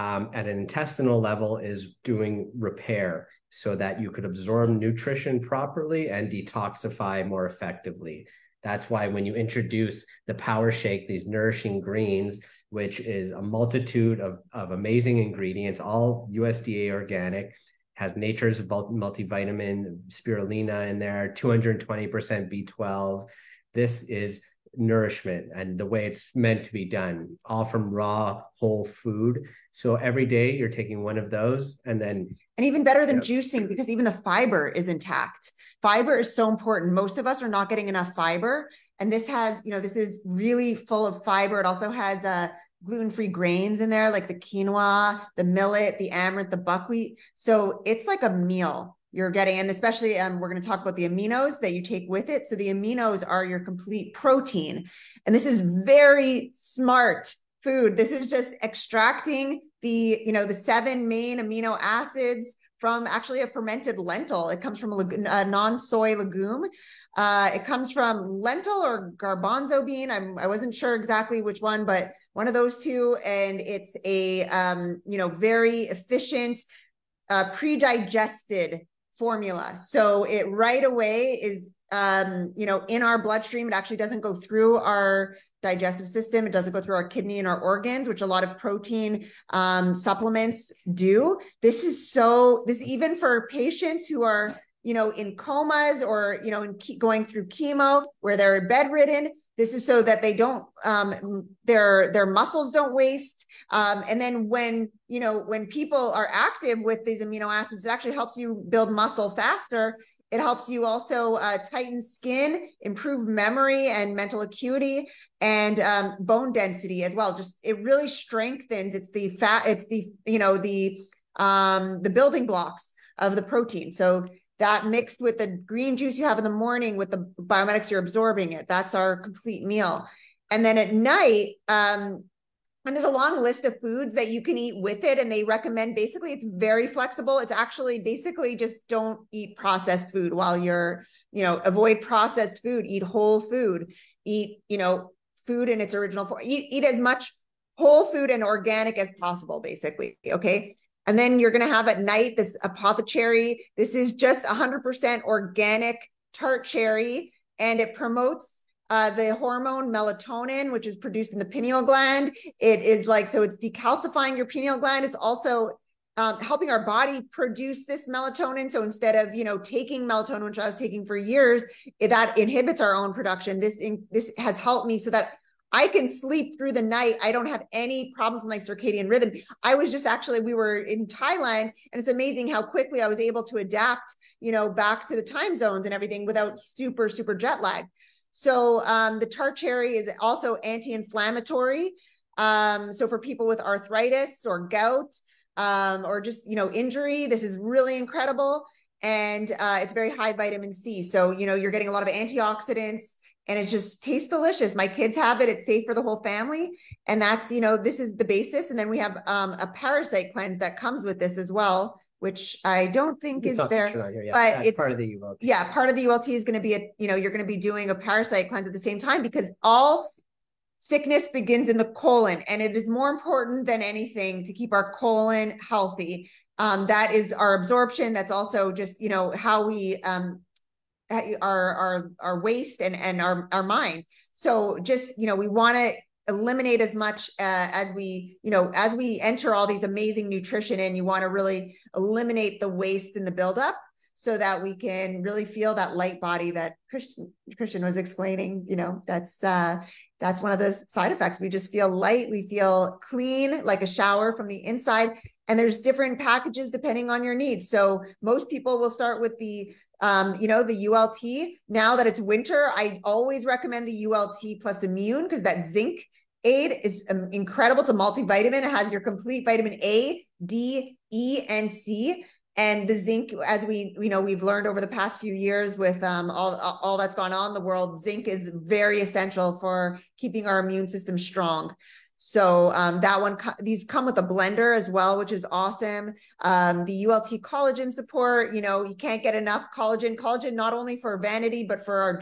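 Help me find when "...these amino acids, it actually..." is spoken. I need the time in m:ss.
1:47.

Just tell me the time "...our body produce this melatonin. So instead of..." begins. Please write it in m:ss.
2:46.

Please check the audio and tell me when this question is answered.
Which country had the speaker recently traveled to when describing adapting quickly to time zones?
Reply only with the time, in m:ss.
3:01.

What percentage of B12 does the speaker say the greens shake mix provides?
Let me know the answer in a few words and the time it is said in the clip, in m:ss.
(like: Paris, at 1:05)
220%, at 0:21.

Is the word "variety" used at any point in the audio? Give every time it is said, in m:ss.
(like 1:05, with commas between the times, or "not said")
not said.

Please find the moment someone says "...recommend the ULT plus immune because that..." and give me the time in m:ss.
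4:23.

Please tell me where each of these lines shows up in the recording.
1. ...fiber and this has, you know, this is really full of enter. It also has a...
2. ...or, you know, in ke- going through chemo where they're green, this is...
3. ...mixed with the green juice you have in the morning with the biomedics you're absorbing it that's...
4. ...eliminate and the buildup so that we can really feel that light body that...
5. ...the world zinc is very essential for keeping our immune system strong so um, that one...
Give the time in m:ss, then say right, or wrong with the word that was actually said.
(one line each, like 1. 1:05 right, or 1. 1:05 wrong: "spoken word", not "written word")
1. 0:38 wrong: "fiber", not "enter"
2. 1:36 wrong: "bedridden", not "green"
3. 2:04 right
4. 4:02 wrong: "waste", not "eliminate"
5. 4:37 right.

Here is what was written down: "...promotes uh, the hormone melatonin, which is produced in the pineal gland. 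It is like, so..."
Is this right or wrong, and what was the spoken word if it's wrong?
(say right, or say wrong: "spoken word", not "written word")
right.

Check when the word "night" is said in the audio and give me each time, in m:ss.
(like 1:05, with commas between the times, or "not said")
2:10, 2:31, 2:56.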